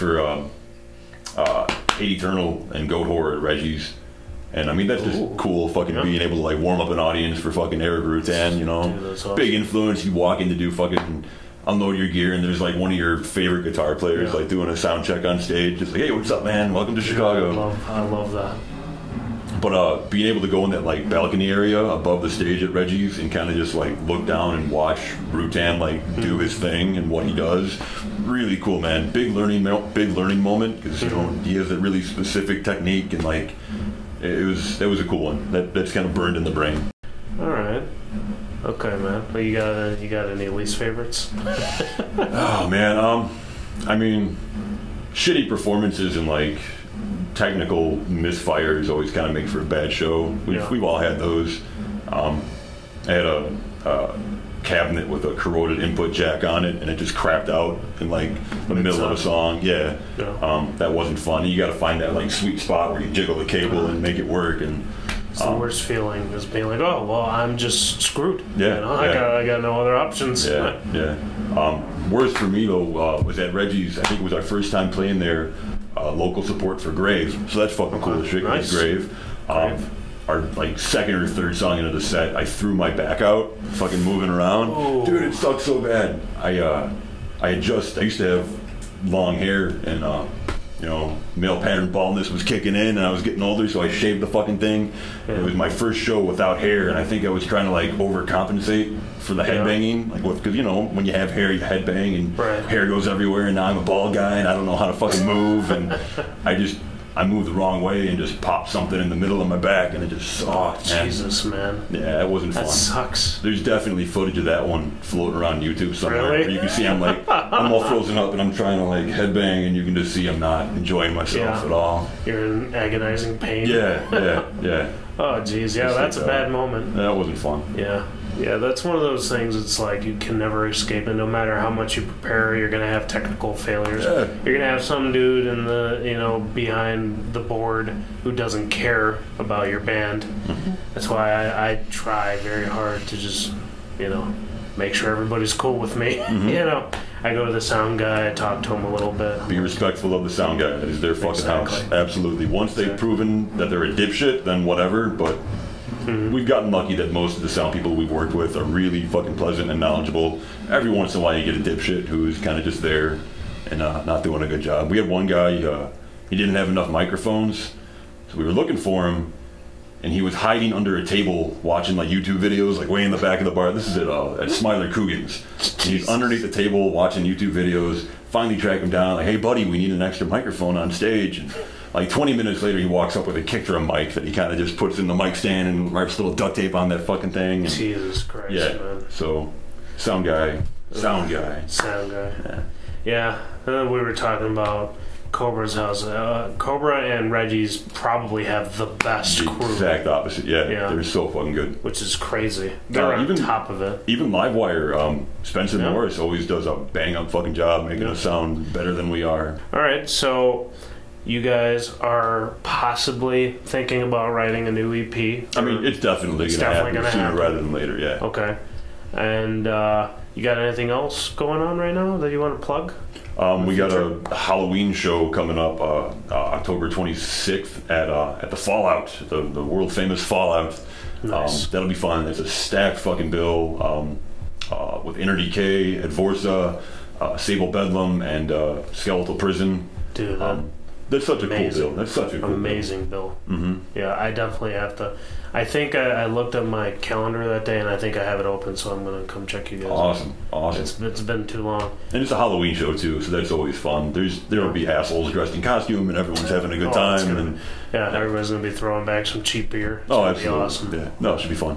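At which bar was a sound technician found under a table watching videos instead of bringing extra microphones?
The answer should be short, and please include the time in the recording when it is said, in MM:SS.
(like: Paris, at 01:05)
Smiler Coogan's, at 02:54.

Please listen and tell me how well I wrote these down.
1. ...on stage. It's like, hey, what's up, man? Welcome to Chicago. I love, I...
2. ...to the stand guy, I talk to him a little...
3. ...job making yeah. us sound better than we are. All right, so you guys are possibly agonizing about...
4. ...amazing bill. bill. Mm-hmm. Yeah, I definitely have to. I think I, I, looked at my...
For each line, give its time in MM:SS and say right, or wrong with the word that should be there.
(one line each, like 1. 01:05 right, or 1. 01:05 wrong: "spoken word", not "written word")
1. 00:15 right
2. 02:27 wrong: "sound", not "stand"
3. 03:27 wrong: "thinking", not "agonizing"
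4. 04:02 right.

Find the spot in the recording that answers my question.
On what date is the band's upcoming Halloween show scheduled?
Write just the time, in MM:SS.
03:46.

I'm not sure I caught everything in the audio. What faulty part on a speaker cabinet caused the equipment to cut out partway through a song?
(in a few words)
Corroded input jack.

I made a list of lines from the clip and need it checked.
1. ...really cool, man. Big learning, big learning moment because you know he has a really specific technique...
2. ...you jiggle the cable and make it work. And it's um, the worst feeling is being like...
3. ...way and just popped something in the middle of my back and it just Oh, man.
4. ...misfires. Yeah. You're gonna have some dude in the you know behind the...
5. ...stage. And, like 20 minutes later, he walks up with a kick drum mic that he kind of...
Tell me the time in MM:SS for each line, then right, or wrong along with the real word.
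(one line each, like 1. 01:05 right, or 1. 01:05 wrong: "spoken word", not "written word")
1. 00:28 right
2. 01:03 right
3. 01:47 right
4. 02:13 wrong: "failures", not "misfires"
5. 03:00 right.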